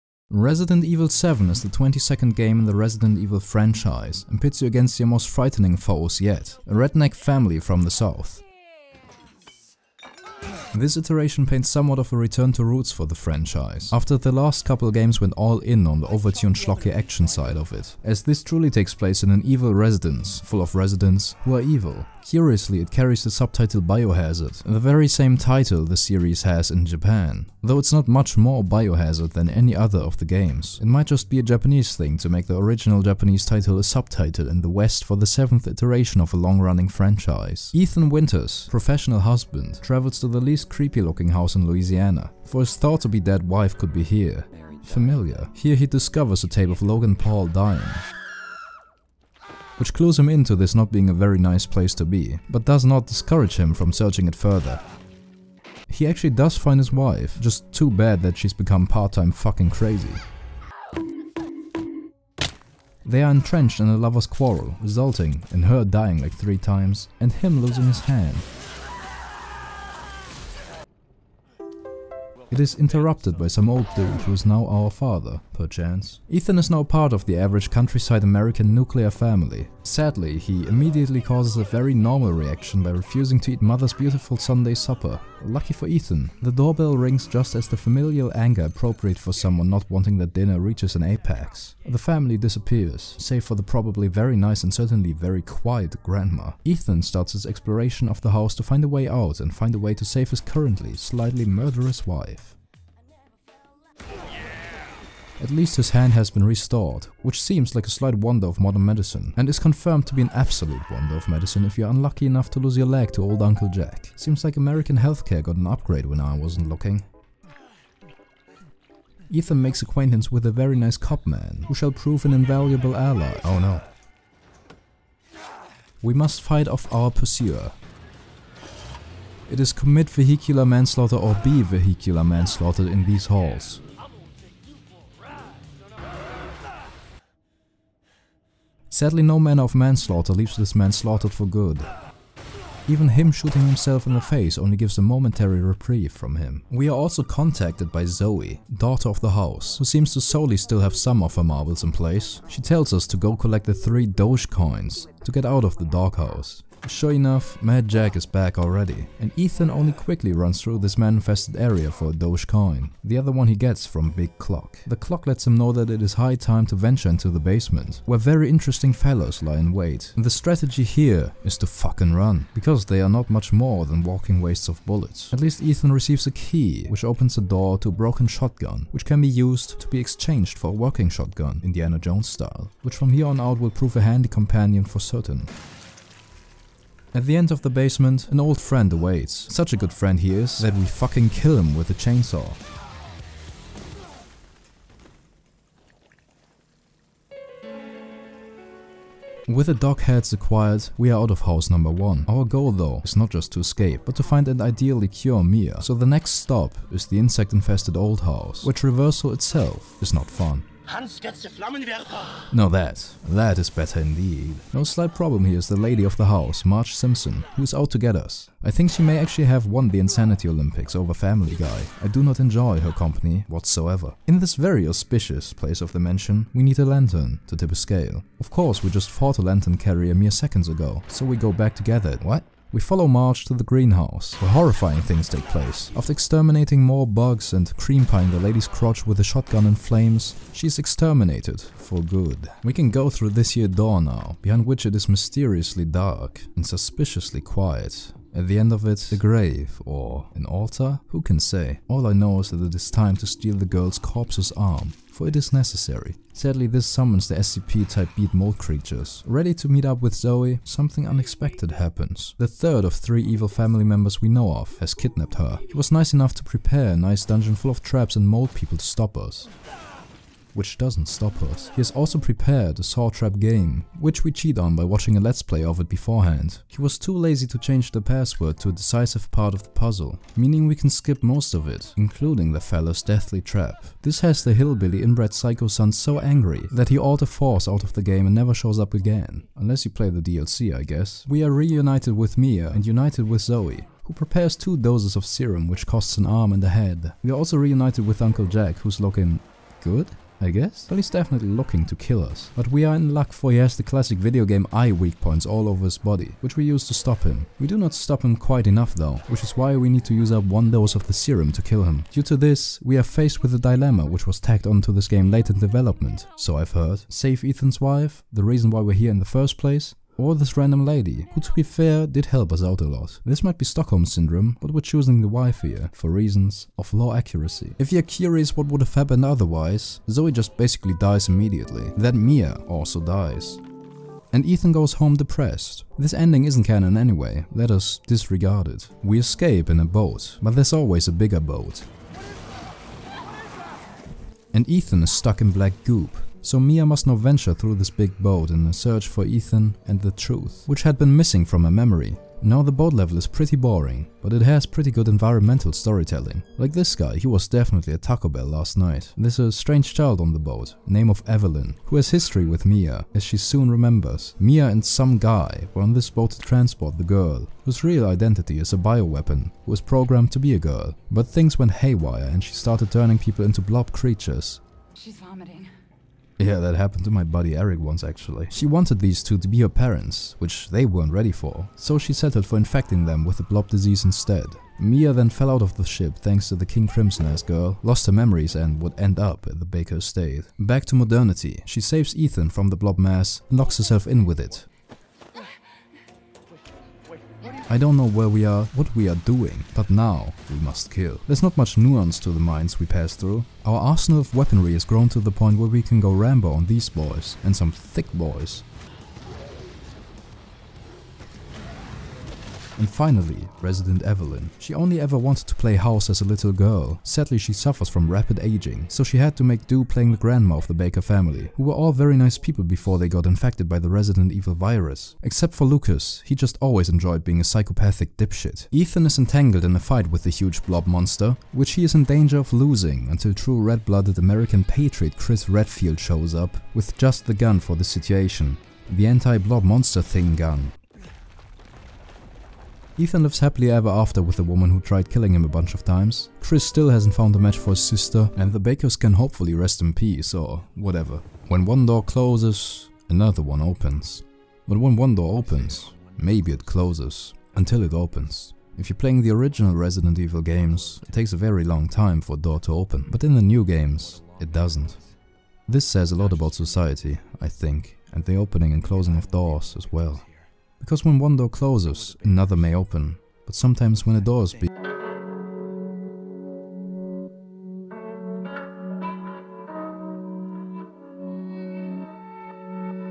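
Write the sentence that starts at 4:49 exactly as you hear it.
Unless you play the DLC, I guess.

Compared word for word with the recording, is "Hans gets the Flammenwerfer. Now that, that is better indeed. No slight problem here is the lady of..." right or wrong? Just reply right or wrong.
right.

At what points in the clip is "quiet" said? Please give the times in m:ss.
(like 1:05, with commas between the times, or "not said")
1:35, 4:07.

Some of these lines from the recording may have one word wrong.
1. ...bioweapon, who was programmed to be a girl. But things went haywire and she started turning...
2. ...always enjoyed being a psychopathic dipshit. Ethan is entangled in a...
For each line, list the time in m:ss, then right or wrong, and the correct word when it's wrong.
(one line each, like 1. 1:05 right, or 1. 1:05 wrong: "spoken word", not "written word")
1. 6:08 right
2. 7:06 right.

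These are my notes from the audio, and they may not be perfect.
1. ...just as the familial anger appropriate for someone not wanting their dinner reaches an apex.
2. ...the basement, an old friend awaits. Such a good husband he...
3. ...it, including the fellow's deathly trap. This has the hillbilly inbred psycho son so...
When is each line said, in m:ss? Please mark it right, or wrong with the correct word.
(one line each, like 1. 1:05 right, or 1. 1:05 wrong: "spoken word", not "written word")
1. 1:27 right
2. 3:07 wrong: "friend", not "husband"
3. 4:41 right.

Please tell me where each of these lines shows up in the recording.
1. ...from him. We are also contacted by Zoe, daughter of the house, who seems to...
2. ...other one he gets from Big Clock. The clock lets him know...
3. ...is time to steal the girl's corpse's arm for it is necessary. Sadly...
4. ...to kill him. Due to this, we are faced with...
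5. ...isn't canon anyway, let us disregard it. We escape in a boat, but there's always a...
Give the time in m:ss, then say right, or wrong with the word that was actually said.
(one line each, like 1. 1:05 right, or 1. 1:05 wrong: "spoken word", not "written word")
1. 2:26 right
2. 2:43 right
3. 4:12 right
4. 5:11 right
5. 5:36 right.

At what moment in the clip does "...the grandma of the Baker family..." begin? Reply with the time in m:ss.
7:00.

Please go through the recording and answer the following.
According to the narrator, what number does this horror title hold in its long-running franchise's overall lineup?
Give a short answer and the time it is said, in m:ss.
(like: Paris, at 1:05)
22nd, at 0:01.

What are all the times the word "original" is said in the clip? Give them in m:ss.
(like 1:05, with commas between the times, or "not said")
0:32, 7:39.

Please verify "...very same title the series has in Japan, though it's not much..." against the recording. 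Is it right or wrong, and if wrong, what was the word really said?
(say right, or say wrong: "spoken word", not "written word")
right.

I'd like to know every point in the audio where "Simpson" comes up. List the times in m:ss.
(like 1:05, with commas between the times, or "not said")
3:36.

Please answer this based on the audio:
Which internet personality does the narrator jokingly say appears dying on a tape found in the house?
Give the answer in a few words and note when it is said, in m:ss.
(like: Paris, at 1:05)
Logan Paul, at 0:46.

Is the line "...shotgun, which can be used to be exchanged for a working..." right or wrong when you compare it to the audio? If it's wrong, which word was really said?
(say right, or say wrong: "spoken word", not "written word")
right.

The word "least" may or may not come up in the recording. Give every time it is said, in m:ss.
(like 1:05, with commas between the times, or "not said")
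0:40, 1:45, 2:55.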